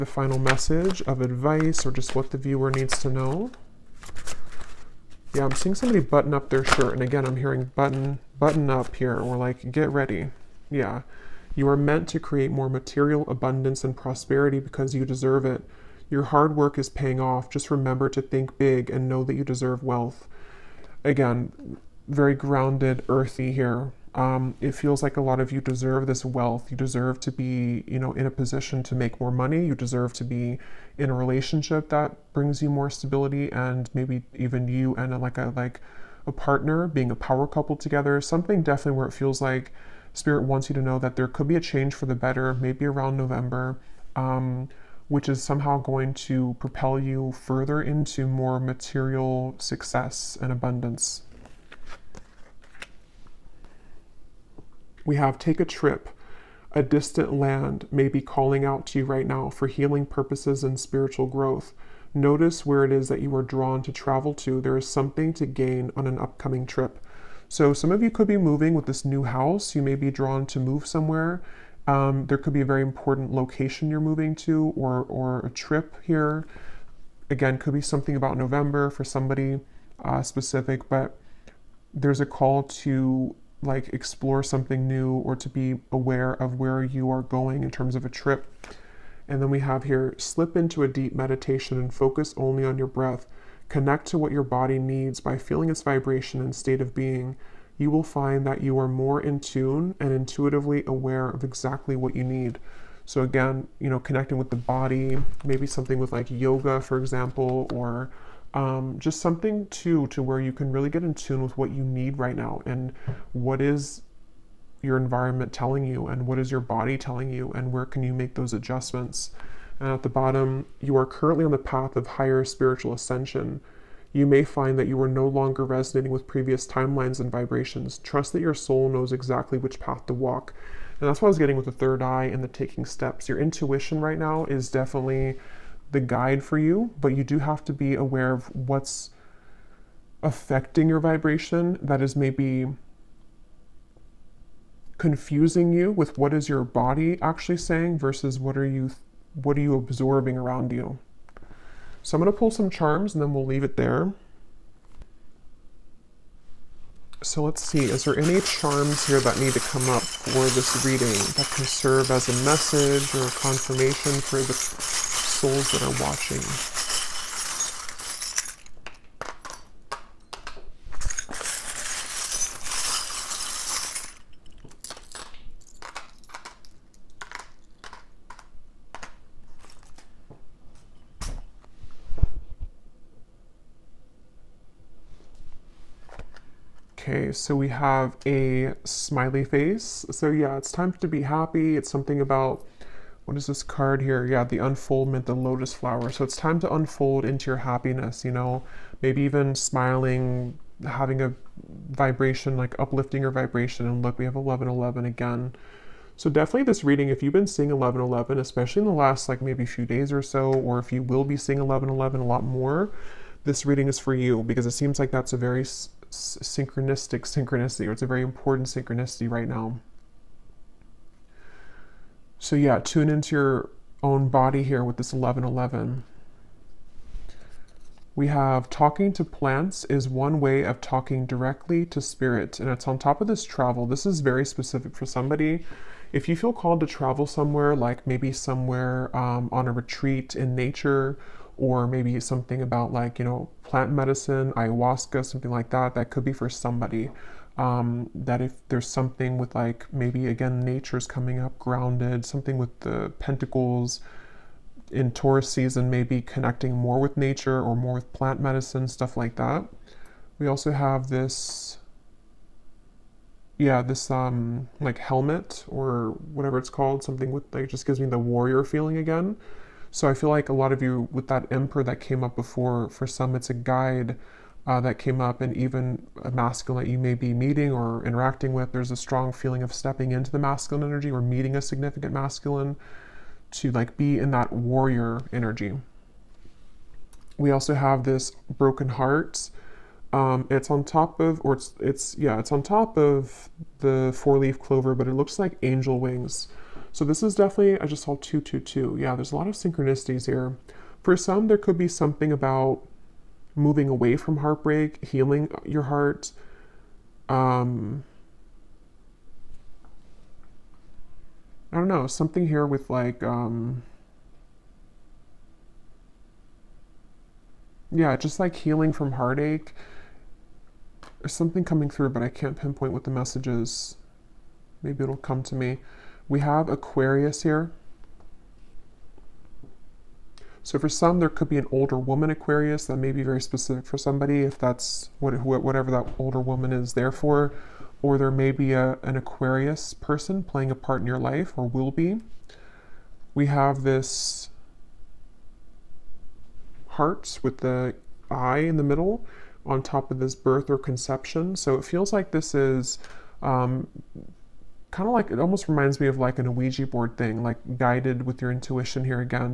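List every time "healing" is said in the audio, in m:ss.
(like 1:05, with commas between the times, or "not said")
0:59, 5:05, 5:18.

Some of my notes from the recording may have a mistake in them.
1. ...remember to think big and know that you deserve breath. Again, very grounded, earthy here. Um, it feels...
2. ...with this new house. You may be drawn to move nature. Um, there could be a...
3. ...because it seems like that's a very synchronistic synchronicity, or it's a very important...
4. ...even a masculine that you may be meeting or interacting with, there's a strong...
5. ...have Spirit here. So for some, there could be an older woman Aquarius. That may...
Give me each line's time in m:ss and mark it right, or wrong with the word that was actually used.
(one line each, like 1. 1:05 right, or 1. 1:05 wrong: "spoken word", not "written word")
1. 0:17 wrong: "wealth", not "breath"
2. 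1:08 wrong: "somewhere", not "nature"
3. 3:34 right
4. 4:35 right
5. 5:26 wrong: "Aquarius", not "Spirit".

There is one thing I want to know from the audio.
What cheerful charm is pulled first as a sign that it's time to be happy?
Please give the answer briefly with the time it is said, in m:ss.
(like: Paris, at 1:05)
smiley face, at 3:08.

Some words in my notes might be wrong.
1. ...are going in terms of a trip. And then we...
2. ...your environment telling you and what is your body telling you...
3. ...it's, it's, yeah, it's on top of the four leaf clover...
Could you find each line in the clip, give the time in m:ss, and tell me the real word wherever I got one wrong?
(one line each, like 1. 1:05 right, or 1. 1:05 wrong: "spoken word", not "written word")
1. 1:27 right
2. 1:54 right
3. 4:51 right.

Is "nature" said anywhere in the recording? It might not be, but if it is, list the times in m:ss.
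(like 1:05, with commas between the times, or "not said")
4:00, 4:10, 4:17.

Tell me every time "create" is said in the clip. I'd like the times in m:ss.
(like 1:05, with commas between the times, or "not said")
0:12.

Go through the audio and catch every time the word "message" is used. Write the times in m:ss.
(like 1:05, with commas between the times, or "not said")
0:00, 2:42, 5:23.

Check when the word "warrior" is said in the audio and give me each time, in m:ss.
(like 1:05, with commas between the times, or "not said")
4:28, 4:44.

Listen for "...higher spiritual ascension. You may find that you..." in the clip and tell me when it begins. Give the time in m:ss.
2:02.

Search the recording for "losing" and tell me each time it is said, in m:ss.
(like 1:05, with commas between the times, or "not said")
not said.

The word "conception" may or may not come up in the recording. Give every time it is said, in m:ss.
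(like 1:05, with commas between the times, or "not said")
5:50.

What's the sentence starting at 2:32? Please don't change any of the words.
So I'm going to pull some charms and then we'll leave it there.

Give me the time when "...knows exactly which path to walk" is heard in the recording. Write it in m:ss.
2:08.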